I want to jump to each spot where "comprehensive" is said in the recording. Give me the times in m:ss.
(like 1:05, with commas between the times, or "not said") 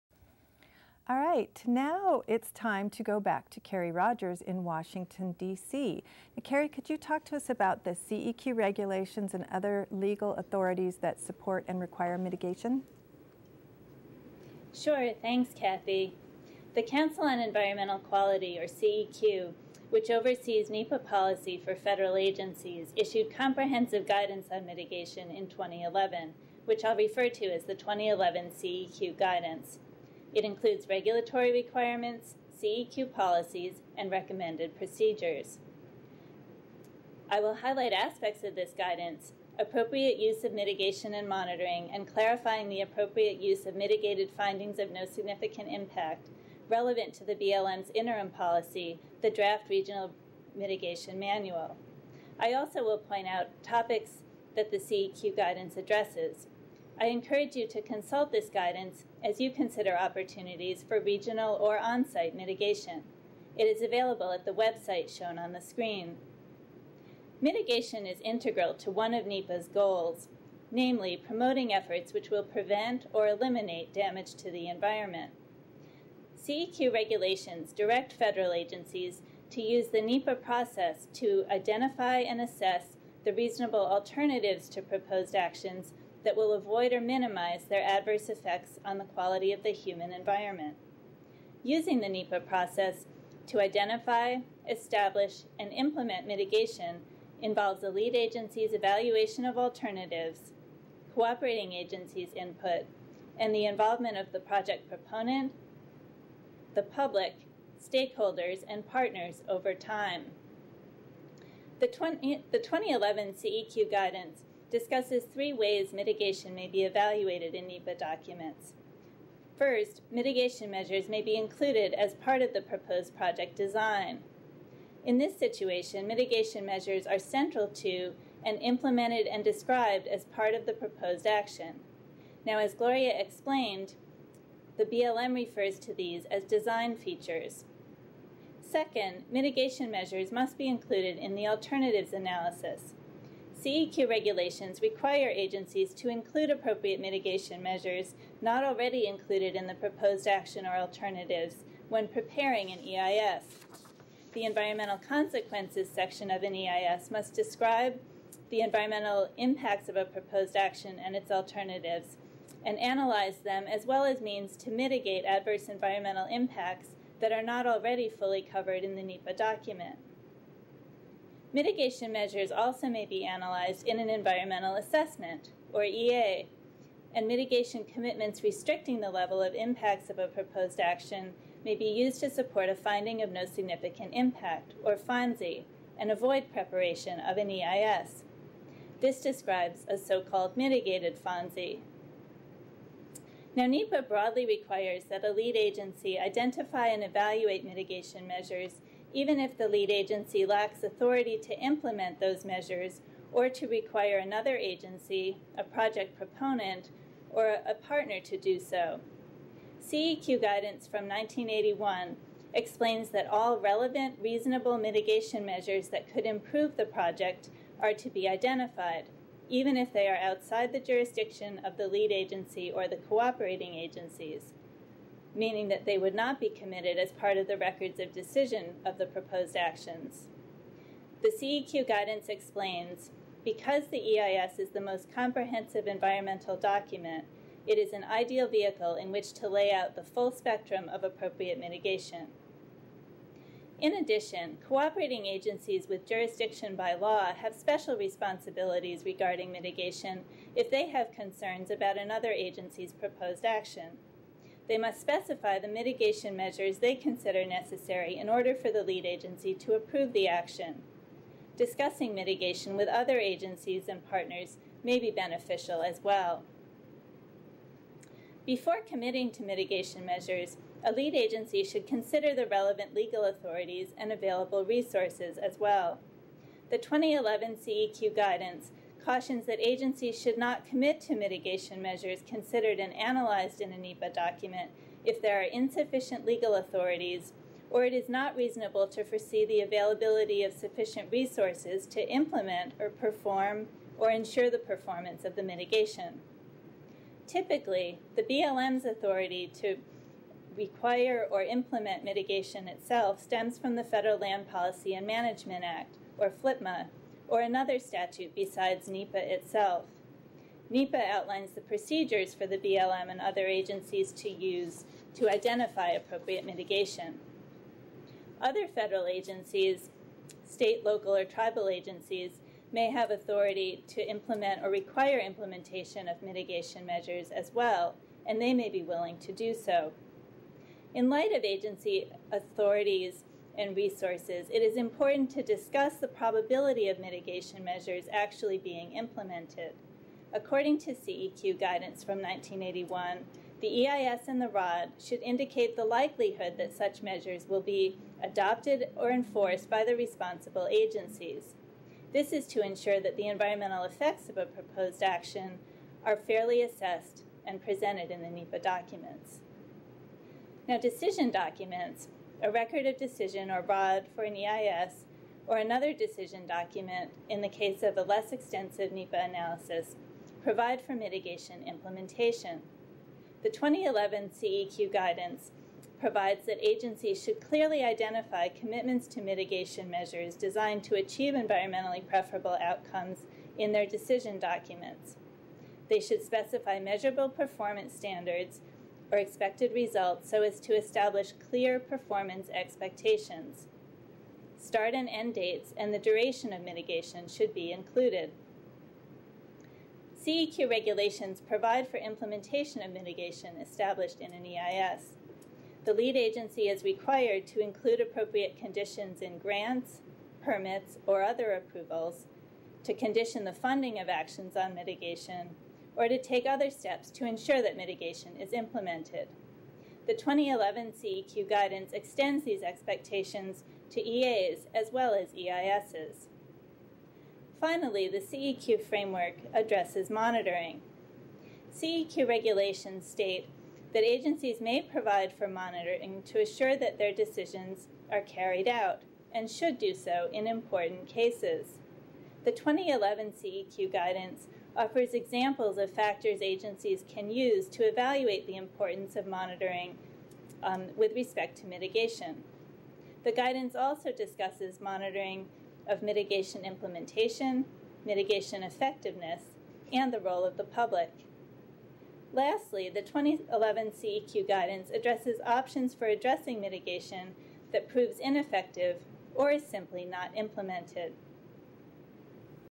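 0:23, 3:55.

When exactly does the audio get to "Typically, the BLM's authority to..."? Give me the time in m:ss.
4:57.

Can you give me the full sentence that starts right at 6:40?
CEQ regulations provide for implementation of mitigation established in an EIS.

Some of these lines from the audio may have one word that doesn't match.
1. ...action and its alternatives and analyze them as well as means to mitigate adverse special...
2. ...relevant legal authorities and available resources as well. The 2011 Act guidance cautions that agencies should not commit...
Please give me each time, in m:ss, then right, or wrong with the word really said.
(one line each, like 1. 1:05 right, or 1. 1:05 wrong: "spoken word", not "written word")
1. 2:40 wrong: "environmental", not "special"
2. 4:32 wrong: "CEQ", not "Act".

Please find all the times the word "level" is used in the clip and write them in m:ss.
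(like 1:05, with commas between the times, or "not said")
2:59.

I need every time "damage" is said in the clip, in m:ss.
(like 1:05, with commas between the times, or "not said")
1:13.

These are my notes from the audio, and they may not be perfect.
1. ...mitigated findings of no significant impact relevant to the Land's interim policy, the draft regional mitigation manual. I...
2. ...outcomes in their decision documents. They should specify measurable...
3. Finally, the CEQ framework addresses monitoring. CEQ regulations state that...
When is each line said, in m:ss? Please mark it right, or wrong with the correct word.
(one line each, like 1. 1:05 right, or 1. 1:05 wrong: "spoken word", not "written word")
1. 0:43 wrong: "BLM", not "Land"
2. 6:22 right
3. 7:07 right.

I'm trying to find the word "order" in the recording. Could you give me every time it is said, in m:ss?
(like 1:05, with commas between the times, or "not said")
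4:18.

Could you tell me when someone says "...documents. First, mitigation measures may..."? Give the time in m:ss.
1:57.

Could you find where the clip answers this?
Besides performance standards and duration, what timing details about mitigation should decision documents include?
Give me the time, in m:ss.
6:34.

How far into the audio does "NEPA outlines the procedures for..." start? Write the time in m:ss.
5:10.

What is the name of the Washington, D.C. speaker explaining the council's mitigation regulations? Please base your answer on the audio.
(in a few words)
Kerry Rodgers.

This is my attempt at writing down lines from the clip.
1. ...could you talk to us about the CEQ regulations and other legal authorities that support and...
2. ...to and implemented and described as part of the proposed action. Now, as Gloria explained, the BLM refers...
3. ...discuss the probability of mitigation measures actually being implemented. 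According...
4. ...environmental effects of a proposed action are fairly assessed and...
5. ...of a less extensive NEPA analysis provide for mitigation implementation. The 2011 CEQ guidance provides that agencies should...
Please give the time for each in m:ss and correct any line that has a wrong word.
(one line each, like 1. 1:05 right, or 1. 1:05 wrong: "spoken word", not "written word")
1. 0:06 right
2. 2:07 right
3. 5:35 right
4. 5:53 right
5. 6:07 right.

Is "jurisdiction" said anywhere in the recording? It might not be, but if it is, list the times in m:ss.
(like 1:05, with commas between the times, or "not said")
3:40, 4:06.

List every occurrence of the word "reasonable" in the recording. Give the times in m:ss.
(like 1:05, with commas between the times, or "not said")
1:23, 3:34, 4:48.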